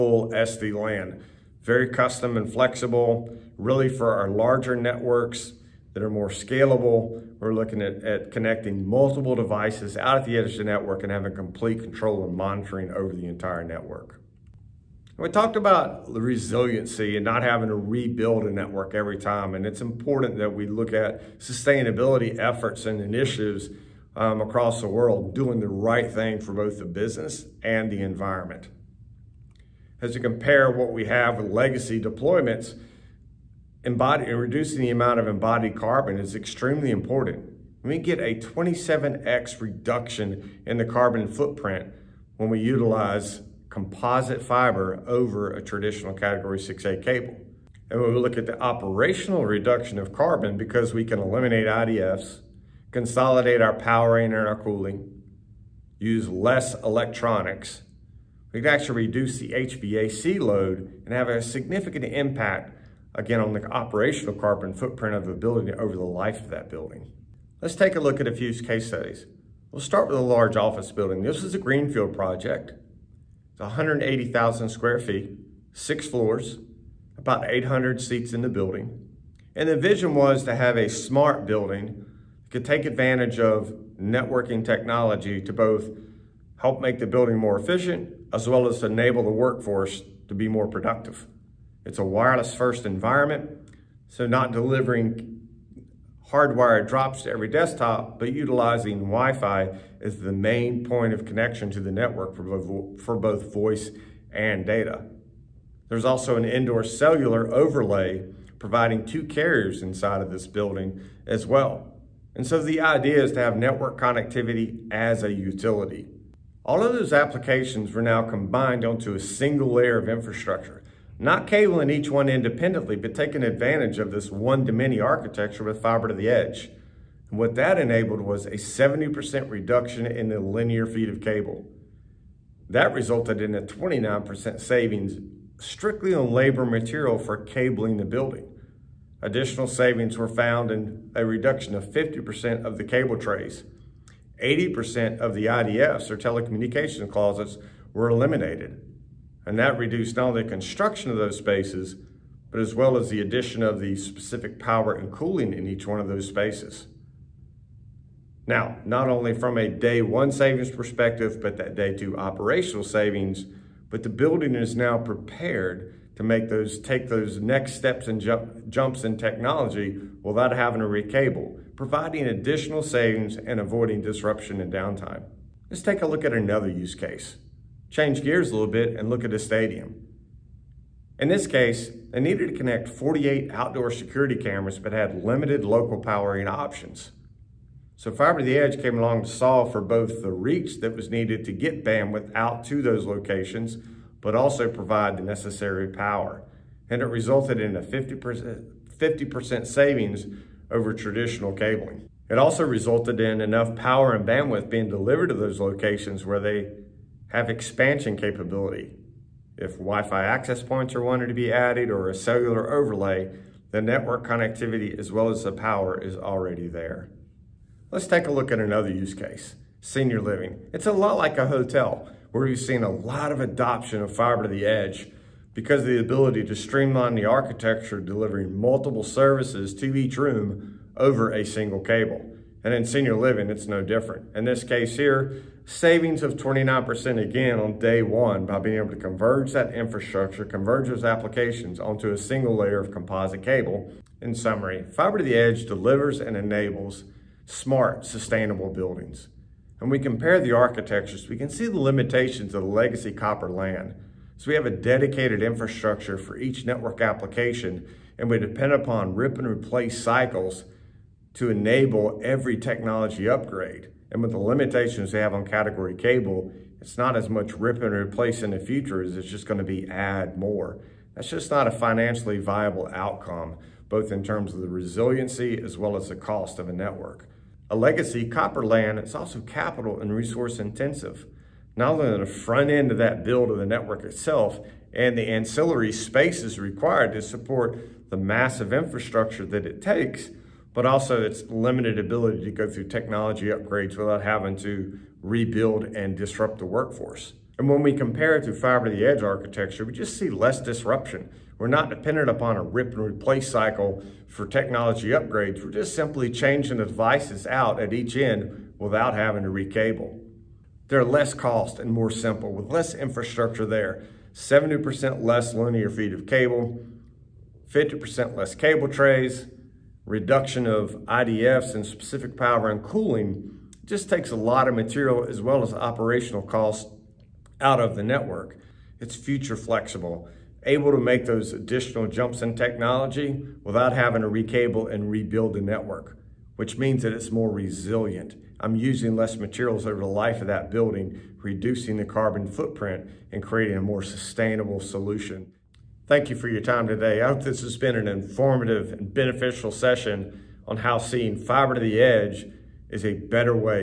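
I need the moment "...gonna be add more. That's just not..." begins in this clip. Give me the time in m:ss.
4:29.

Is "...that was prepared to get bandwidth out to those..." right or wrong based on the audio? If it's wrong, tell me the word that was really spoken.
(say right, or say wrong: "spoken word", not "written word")
wrong: "needed", not "prepared".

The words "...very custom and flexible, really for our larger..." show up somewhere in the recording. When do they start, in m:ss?
0:01.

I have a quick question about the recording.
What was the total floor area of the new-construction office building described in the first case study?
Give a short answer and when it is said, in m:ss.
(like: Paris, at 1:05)
180,000 square feet, at 1:13.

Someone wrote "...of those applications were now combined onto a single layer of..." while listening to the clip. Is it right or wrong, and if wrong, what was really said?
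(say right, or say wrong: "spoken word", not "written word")
right.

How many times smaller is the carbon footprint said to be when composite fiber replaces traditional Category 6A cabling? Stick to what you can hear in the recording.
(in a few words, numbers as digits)
27x.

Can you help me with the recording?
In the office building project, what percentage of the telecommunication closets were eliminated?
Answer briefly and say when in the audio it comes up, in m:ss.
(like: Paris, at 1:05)
80%, at 2:24.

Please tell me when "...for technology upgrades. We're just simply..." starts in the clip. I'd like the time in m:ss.
5:04.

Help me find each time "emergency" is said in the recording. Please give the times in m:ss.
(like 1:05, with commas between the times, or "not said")
not said.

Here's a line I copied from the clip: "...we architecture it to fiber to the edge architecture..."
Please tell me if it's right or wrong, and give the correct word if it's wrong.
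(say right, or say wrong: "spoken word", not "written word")
wrong: "compare", not "architecture".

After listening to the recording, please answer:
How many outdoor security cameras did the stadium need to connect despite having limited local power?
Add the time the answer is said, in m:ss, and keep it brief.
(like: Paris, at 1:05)
48, at 3:02.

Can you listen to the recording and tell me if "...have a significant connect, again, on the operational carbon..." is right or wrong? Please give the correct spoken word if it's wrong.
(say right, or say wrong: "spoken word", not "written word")
wrong: "impact", not "connect".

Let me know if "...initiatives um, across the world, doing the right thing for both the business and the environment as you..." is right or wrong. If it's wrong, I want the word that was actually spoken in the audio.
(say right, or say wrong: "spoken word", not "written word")
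right.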